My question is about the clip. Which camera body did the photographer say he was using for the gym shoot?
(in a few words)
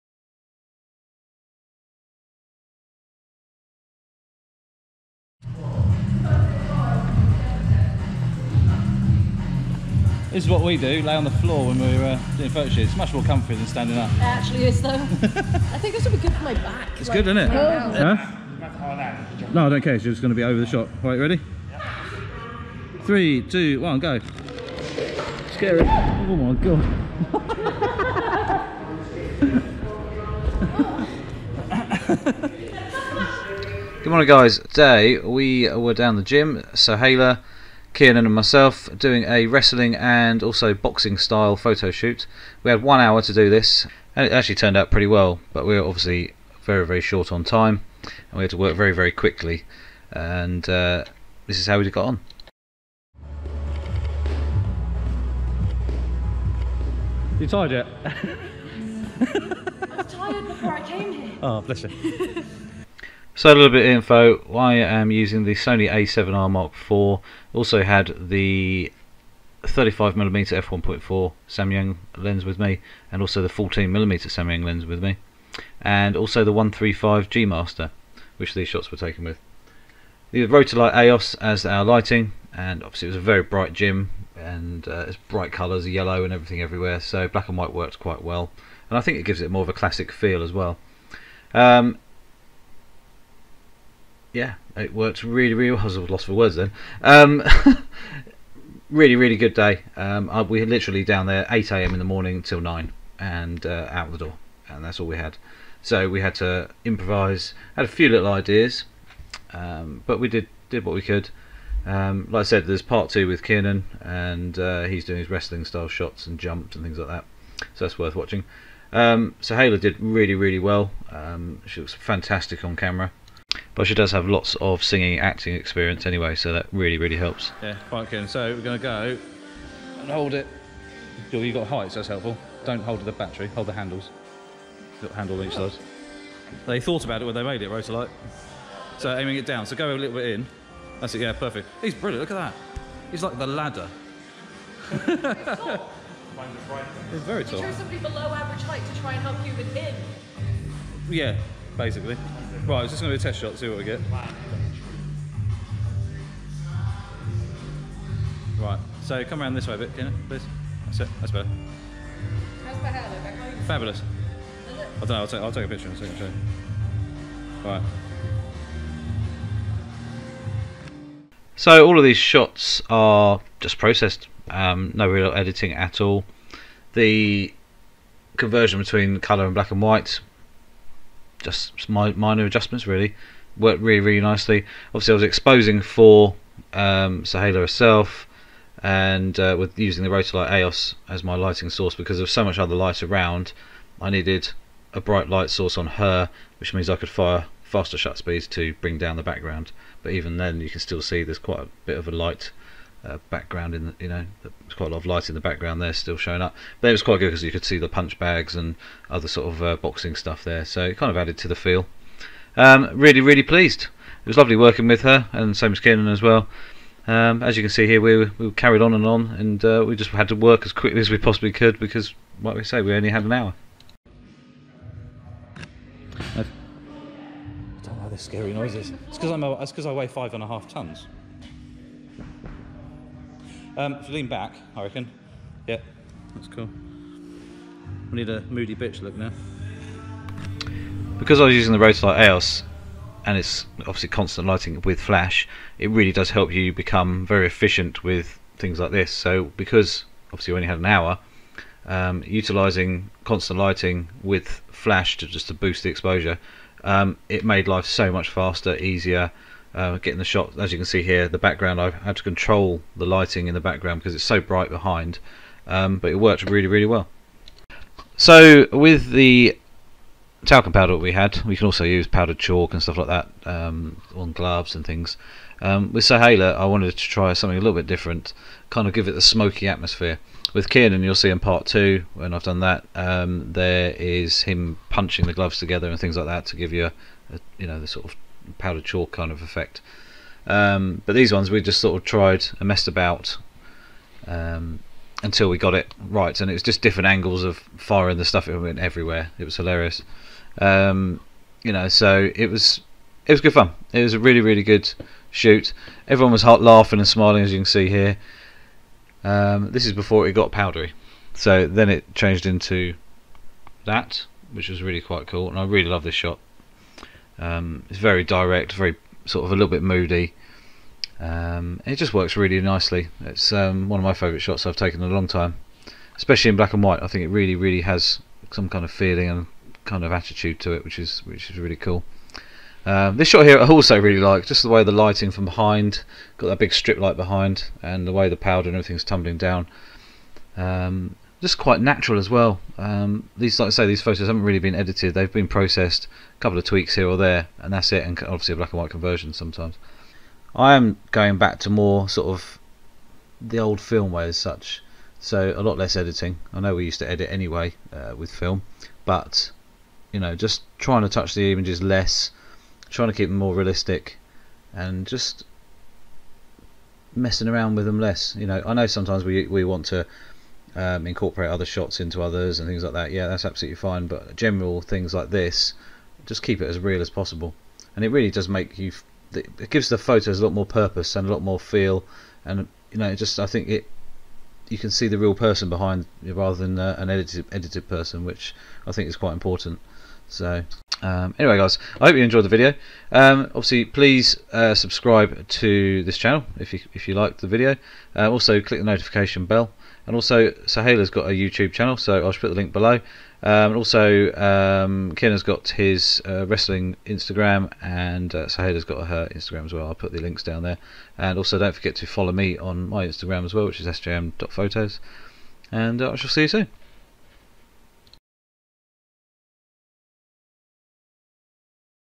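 Sony a7R Mark IV.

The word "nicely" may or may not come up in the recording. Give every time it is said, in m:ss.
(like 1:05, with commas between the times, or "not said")
3:04, 5:22.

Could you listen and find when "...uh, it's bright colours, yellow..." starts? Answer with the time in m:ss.
1:24.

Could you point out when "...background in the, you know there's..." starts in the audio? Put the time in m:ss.
3:23.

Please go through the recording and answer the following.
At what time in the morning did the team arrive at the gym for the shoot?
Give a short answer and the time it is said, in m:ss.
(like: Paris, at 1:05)
8 a.m., at 1:41.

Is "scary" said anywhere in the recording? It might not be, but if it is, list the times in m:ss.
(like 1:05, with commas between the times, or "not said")
0:25, 3:48.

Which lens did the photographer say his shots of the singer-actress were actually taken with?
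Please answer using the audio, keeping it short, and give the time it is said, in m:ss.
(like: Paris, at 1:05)
135 G Master, at 1:16.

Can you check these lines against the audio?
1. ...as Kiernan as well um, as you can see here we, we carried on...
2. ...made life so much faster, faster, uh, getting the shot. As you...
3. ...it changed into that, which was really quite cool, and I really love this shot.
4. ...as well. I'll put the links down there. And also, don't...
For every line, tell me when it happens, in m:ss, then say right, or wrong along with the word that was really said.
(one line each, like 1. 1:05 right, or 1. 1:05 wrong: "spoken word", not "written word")
1. 3:35 right
2. 4:17 wrong: "easier", not "faster"
3. 5:11 right
4. 6:49 right.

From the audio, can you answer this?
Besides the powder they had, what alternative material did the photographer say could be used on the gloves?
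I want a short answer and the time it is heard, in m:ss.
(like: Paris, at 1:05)
Powdered chalk, at 4:32.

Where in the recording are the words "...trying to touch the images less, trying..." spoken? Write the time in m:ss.
6:00.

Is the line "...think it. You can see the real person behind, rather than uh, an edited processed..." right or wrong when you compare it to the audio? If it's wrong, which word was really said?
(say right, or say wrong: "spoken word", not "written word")
wrong: "edited", not "processed".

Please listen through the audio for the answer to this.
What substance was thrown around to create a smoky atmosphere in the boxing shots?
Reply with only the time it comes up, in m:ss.
4:30.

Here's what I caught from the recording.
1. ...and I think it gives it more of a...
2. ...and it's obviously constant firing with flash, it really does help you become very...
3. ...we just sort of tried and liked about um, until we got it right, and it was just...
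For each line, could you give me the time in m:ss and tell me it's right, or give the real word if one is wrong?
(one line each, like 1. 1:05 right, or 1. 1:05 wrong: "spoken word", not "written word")
1. 1:28 right
2. 4:03 wrong: "lighting", not "firing"
3. 4:51 wrong: "messed", not "liked".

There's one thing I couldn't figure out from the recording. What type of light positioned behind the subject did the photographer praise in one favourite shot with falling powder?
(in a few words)
Strip light.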